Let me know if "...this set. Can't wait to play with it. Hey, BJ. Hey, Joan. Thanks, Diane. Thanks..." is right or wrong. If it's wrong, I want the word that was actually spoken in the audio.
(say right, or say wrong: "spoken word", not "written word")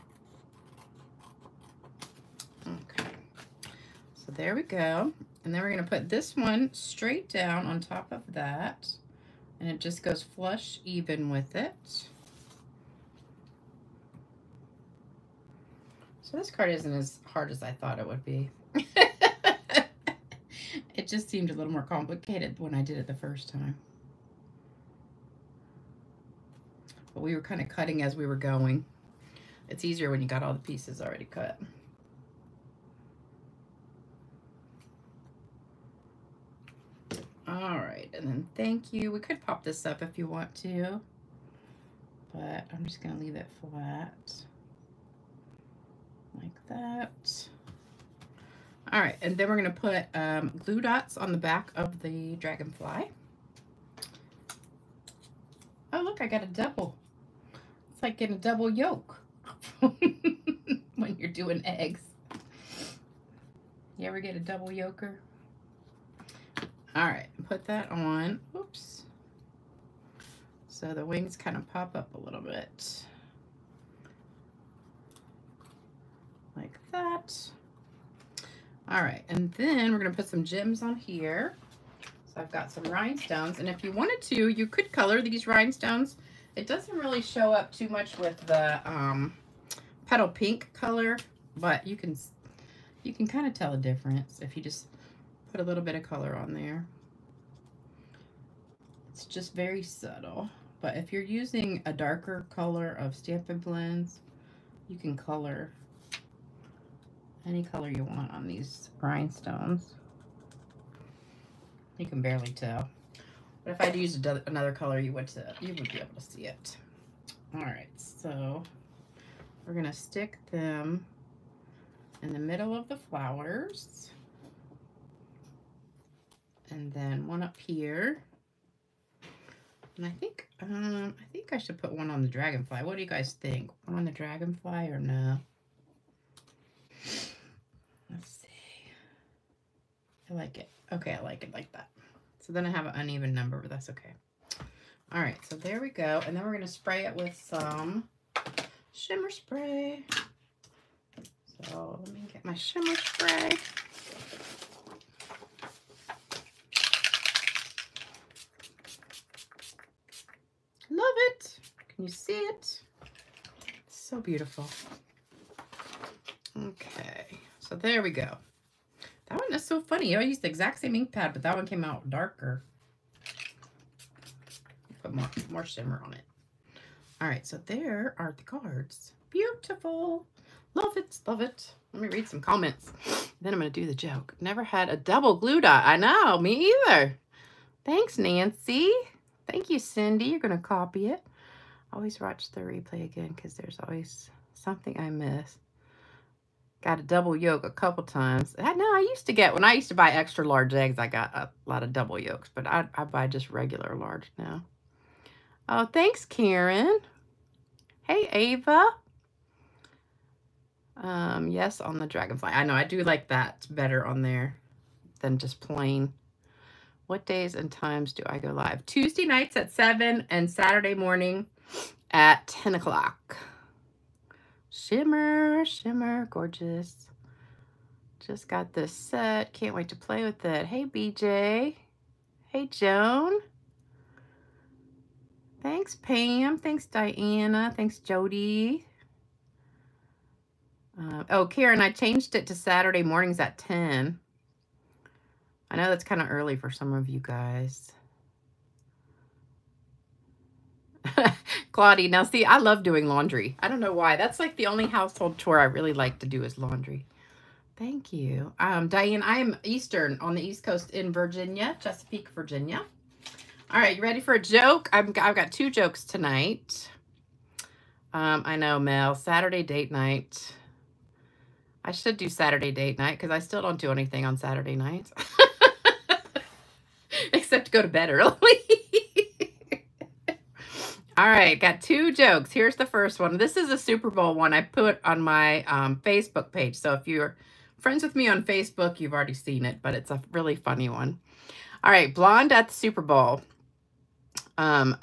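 wrong: "Pam", not "Diane".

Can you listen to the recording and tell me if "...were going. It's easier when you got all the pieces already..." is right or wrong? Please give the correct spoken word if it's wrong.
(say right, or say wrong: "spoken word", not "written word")
right.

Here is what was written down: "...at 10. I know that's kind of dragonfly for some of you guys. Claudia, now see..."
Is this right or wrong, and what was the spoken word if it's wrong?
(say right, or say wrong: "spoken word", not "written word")
wrong: "early", not "dragonfly".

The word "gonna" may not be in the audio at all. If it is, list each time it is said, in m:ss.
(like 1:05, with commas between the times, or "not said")
0:05, 0:43, 0:49, 1:19, 1:59.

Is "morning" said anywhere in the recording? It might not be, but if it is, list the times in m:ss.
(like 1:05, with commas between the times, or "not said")
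3:40, 4:03.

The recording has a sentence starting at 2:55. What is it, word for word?
Put more, more shimmer on it.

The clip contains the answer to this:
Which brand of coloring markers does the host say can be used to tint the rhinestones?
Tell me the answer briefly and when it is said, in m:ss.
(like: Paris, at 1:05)
Stampin' Blends, at 1:43.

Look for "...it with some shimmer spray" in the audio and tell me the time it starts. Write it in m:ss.
2:27.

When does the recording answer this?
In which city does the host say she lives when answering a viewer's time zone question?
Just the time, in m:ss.
4:21.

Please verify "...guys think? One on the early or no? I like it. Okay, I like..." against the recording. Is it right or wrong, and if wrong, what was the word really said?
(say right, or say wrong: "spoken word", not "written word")
wrong: "dragonfly", not "early".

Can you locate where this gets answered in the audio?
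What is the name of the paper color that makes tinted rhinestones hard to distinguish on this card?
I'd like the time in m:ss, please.
1:30.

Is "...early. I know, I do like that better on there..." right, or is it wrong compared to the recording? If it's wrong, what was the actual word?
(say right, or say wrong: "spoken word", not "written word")
wrong: "dragonfly", not "early".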